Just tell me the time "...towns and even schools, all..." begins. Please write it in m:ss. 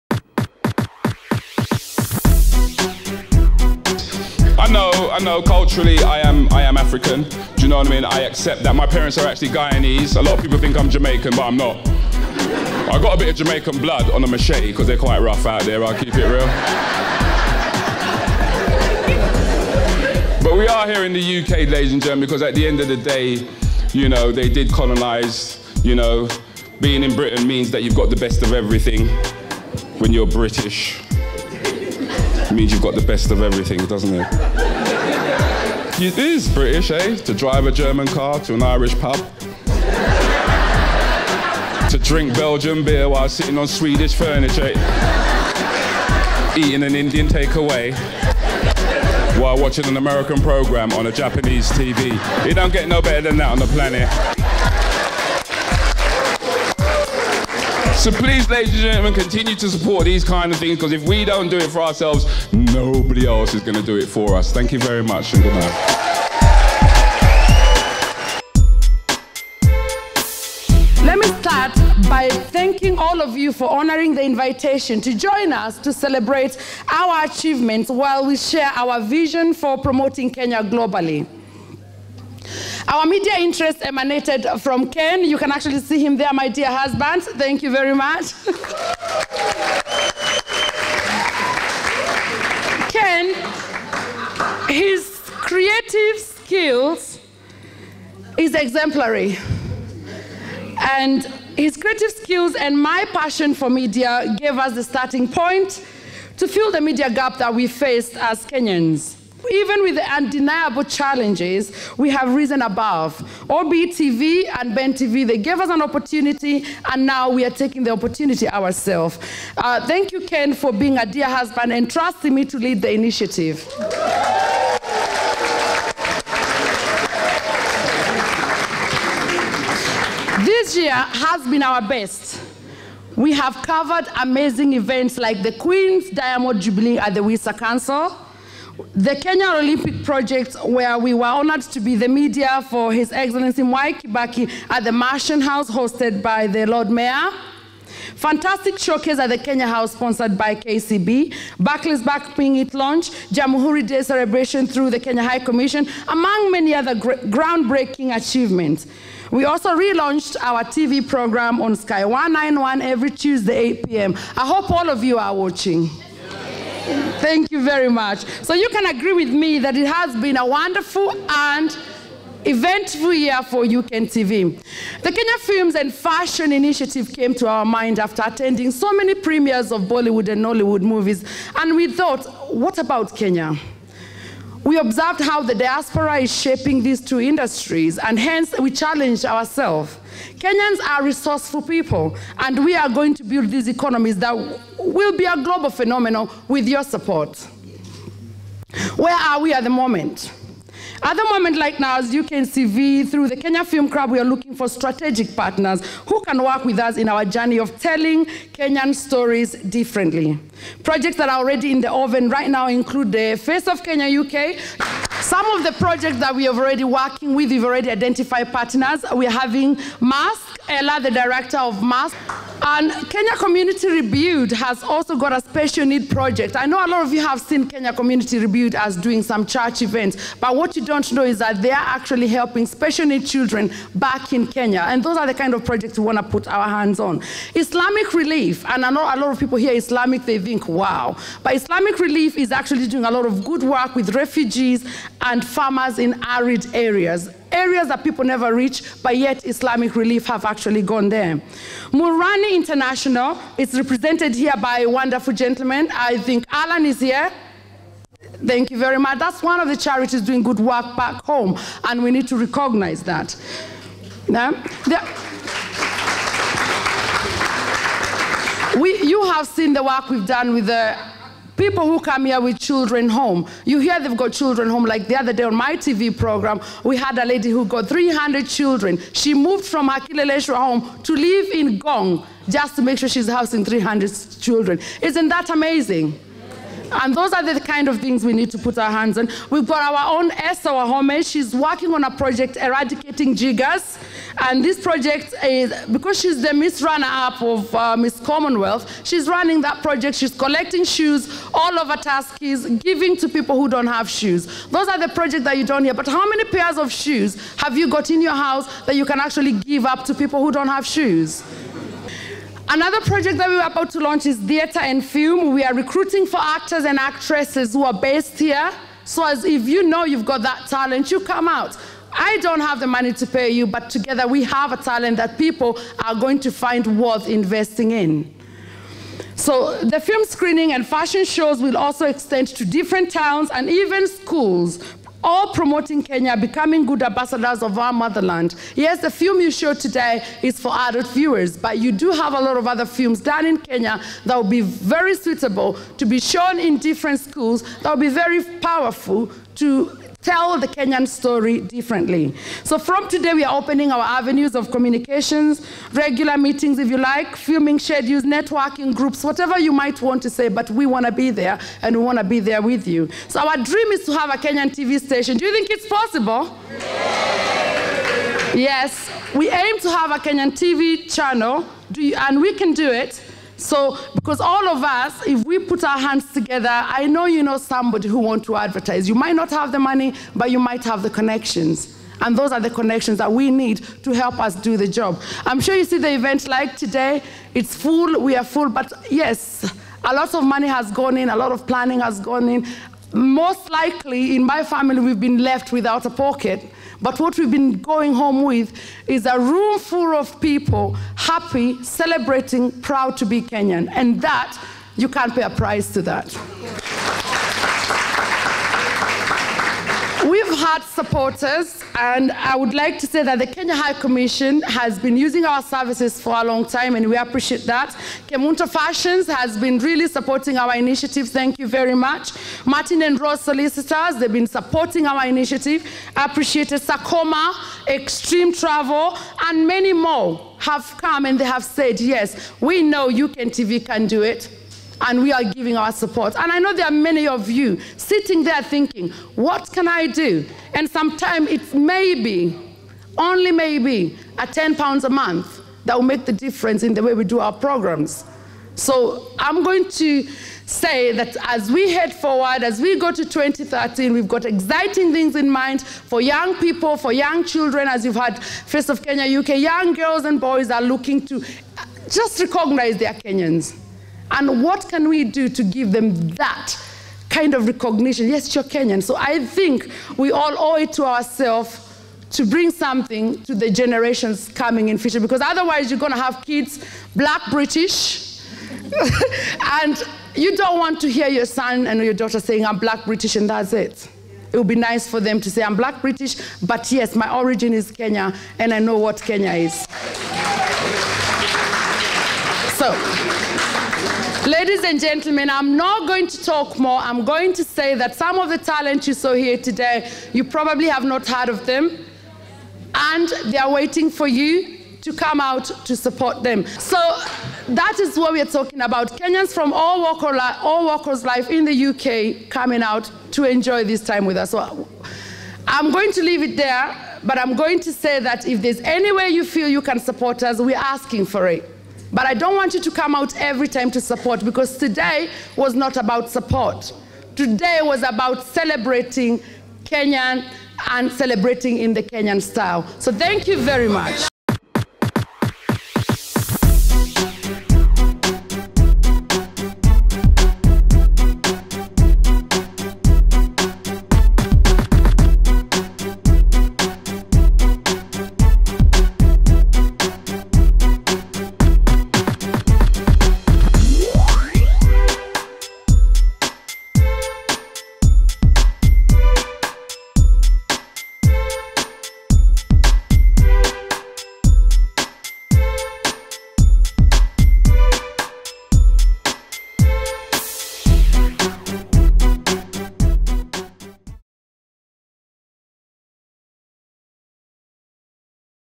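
5:33.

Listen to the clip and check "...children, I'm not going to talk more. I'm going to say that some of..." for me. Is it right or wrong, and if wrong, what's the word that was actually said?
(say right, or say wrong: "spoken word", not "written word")
wrong: "gentlemen", not "children".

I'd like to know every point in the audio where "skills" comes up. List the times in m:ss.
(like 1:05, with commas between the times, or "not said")
1:36, 1:42.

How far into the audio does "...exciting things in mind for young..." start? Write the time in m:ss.
7:34.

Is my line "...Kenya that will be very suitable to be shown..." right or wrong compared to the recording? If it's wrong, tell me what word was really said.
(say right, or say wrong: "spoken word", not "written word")
right.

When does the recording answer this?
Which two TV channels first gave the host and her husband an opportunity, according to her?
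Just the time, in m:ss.
1:53.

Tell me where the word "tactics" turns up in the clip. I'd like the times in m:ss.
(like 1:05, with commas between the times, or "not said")
not said.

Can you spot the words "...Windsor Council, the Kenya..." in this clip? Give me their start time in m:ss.
2:17.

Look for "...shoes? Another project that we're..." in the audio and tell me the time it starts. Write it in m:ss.
5:10.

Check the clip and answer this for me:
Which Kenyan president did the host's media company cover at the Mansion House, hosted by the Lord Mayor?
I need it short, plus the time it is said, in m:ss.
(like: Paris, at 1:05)
Mwai Kibaki, at 2:23.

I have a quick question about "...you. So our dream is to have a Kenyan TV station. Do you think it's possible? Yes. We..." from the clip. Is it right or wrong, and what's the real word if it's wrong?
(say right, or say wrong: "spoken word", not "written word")
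right.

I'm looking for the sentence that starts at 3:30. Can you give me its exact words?
Projects that are already in the oven right now include the Face of Kenya UK.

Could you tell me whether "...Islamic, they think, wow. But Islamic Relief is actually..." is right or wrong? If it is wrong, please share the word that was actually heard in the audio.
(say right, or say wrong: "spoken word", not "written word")
right.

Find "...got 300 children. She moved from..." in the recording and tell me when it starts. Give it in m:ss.
4:37.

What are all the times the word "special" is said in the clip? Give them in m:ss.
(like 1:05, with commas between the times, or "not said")
3:45, 3:52.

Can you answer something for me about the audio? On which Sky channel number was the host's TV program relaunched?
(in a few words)
191.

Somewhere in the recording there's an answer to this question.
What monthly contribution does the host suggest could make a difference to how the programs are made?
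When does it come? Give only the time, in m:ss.
7:24.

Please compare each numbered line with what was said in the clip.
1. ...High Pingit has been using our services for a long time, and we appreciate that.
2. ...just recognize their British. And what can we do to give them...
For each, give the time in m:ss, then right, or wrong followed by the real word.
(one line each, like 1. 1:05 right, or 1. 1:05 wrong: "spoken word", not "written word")
1. 6:53 wrong: "Commission", not "Pingit"
2. 7:42 wrong: "Kenyans", not "British".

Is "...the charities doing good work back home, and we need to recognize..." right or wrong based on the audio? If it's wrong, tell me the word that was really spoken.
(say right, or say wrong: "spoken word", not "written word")
right.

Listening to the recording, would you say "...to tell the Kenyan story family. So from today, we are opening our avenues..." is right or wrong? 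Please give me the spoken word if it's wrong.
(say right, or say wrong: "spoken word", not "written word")
wrong: "differently", not "family".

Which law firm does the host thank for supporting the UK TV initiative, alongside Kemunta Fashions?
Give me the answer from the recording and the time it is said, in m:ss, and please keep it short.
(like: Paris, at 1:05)
Martin and Rose Solicitors, at 7:02.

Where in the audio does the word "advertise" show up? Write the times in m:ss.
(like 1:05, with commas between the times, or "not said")
6:18.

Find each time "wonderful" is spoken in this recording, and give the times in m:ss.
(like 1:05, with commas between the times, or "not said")
2:50, 4:14.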